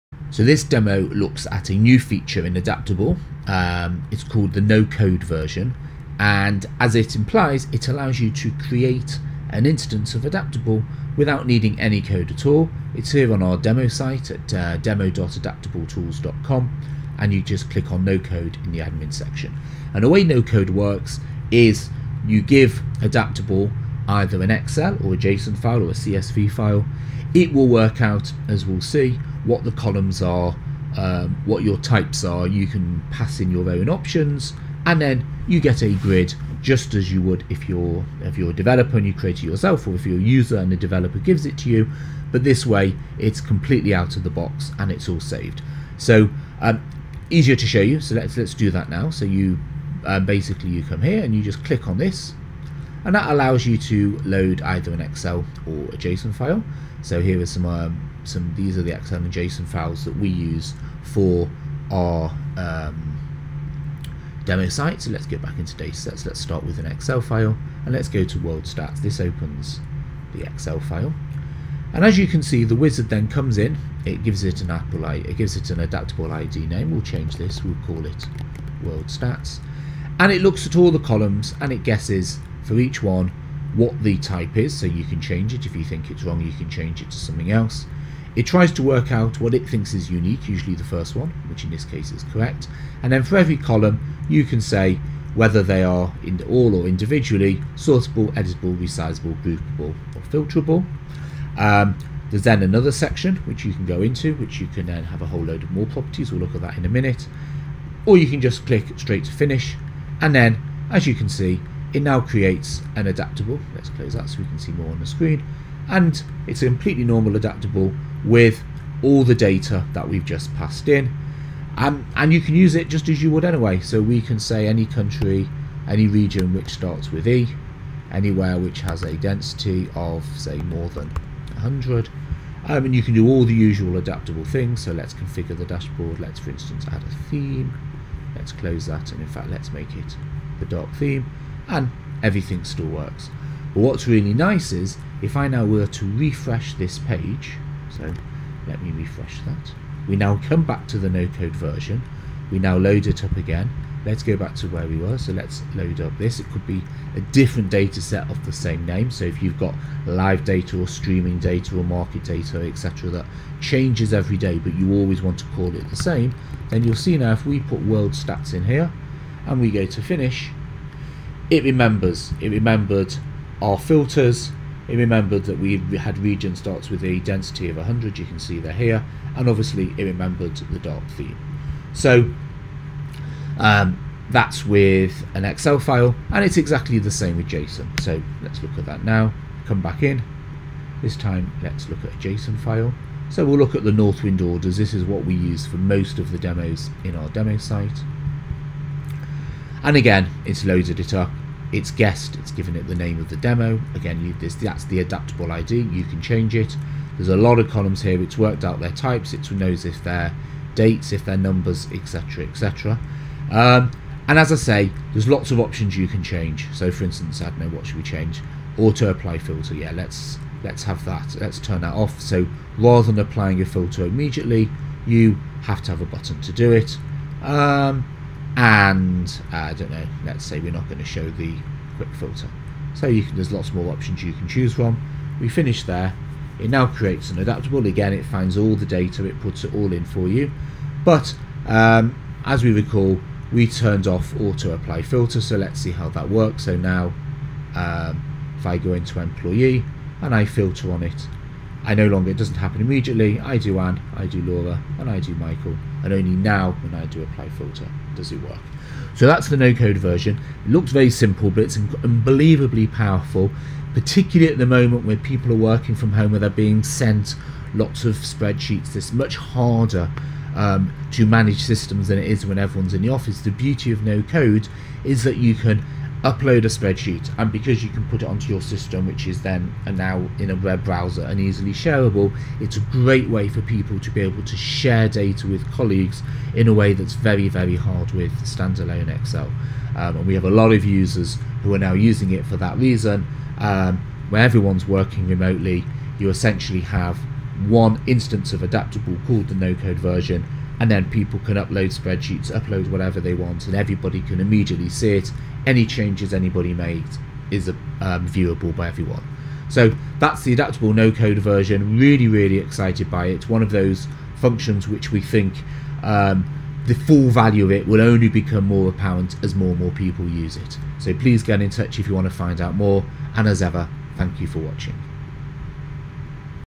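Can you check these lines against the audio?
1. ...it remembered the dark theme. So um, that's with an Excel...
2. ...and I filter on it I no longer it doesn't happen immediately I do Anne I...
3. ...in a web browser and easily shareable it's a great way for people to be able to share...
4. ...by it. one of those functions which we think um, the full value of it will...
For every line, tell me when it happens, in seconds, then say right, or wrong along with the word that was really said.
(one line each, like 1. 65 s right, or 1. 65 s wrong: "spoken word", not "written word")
1. 179 s right
2. 250 s right
3. 280 s right
4. 313 s right.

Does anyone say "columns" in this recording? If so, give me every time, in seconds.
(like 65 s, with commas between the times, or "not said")
29 s, 80 s, 93 s, 207 s.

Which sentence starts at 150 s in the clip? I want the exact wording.
We now come back to the no-code version.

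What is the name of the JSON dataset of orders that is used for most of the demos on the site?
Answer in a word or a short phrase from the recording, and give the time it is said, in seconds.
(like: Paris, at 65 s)
Northwind orders, at 193 s.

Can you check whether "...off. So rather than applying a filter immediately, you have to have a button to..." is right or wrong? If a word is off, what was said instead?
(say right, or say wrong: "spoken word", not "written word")
right.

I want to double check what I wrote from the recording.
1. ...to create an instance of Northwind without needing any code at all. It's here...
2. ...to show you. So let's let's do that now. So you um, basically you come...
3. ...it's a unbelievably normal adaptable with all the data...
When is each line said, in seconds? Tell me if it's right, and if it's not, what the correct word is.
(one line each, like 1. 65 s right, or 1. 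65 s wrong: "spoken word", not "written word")
1. 8 s wrong: "Adaptable", not "Northwind"
2. 47 s right
3. 116 s wrong: "completely", not "unbelievably".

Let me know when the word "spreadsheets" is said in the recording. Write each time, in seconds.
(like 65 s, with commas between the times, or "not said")
268 s, 276 s, 301 s.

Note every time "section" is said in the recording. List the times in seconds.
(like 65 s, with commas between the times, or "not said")
19 s, 102 s.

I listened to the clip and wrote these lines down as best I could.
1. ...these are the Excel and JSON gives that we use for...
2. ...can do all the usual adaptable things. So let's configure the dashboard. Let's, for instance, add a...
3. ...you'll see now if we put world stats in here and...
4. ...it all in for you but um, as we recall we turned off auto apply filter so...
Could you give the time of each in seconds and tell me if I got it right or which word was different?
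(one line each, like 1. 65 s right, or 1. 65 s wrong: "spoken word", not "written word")
1. 58 s wrong: "files", not "gives"
2. 133 s right
3. 166 s right
4. 239 s right.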